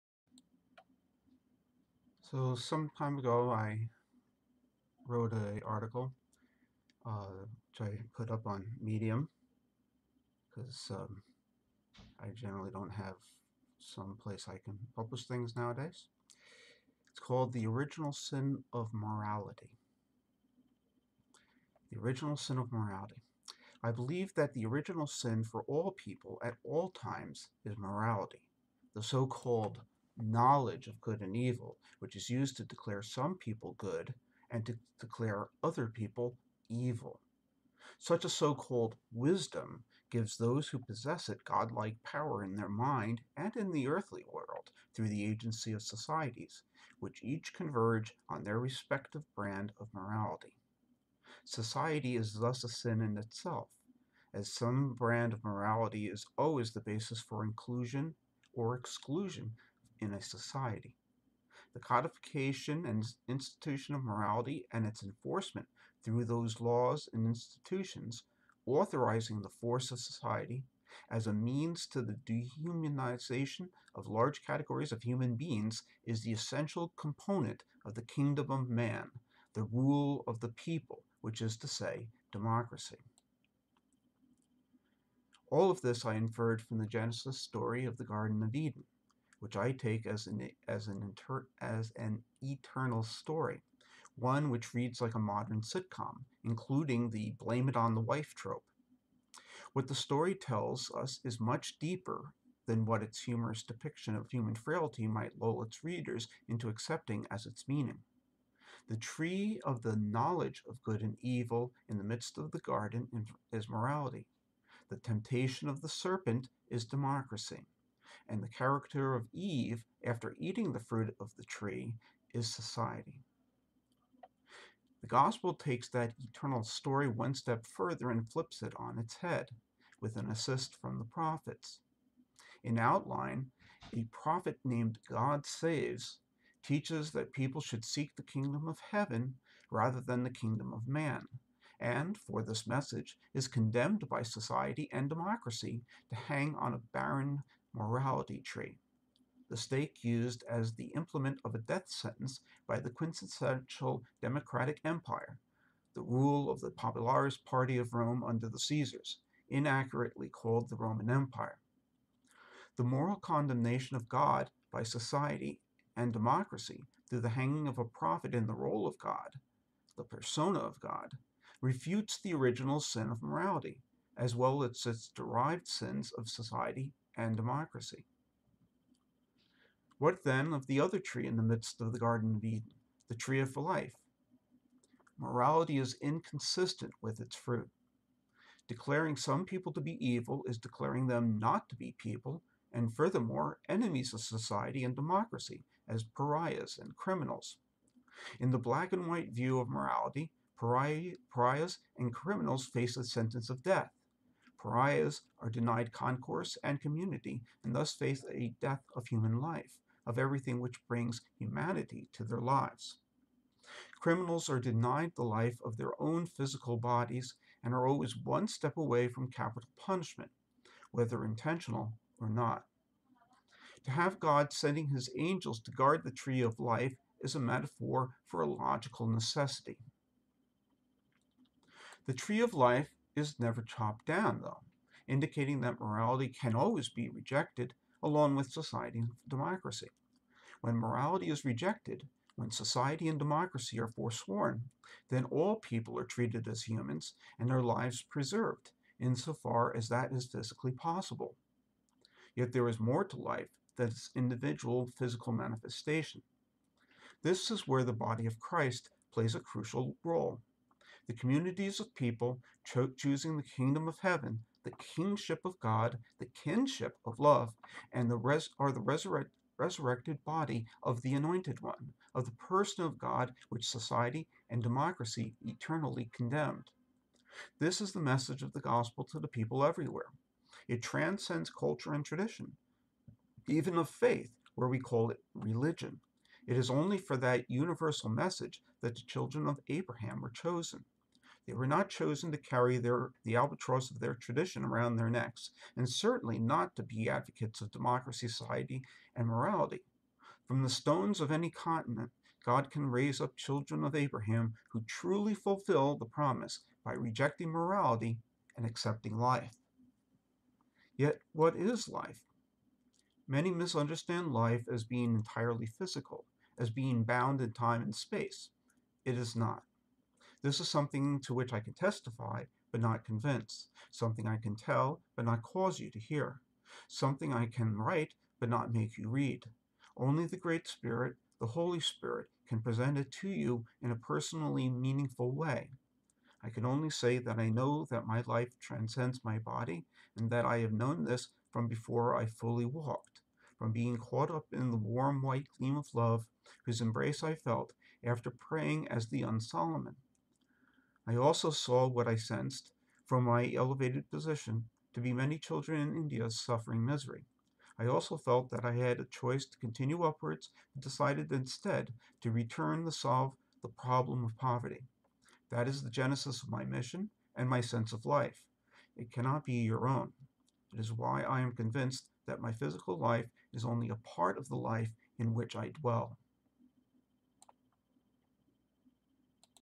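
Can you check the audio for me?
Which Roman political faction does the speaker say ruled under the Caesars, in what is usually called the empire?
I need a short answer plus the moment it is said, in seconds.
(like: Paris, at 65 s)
Popularis Party, at 156 s.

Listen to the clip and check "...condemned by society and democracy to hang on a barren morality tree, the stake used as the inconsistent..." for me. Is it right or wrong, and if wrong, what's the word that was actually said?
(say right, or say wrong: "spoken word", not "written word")
wrong: "implement", not "inconsistent".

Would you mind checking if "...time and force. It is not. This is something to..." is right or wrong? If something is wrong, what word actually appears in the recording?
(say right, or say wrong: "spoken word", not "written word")
wrong: "space", not "force".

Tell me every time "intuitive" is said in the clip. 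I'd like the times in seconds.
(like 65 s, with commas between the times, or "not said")
not said.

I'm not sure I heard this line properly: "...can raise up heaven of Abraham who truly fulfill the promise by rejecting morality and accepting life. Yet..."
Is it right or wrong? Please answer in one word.
wrong.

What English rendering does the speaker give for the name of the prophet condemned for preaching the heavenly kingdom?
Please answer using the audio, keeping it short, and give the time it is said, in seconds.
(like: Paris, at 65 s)
God Saves, at 135 s.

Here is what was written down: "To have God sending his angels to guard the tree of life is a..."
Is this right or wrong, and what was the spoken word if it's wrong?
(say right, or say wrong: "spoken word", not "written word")
right.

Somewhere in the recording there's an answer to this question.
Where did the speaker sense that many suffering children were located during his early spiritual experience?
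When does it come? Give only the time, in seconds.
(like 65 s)
355 s.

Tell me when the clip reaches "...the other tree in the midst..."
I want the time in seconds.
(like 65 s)
180 s.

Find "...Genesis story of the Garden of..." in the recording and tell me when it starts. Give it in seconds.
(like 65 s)
86 s.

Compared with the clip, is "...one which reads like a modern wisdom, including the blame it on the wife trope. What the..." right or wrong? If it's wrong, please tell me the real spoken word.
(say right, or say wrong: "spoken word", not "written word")
wrong: "sitcom", not "wisdom".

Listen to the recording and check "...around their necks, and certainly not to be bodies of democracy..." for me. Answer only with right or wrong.
wrong.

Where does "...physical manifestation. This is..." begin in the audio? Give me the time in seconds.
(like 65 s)
254 s.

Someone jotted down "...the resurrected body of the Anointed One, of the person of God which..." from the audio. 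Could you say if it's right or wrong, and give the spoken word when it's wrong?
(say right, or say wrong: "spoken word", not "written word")
right.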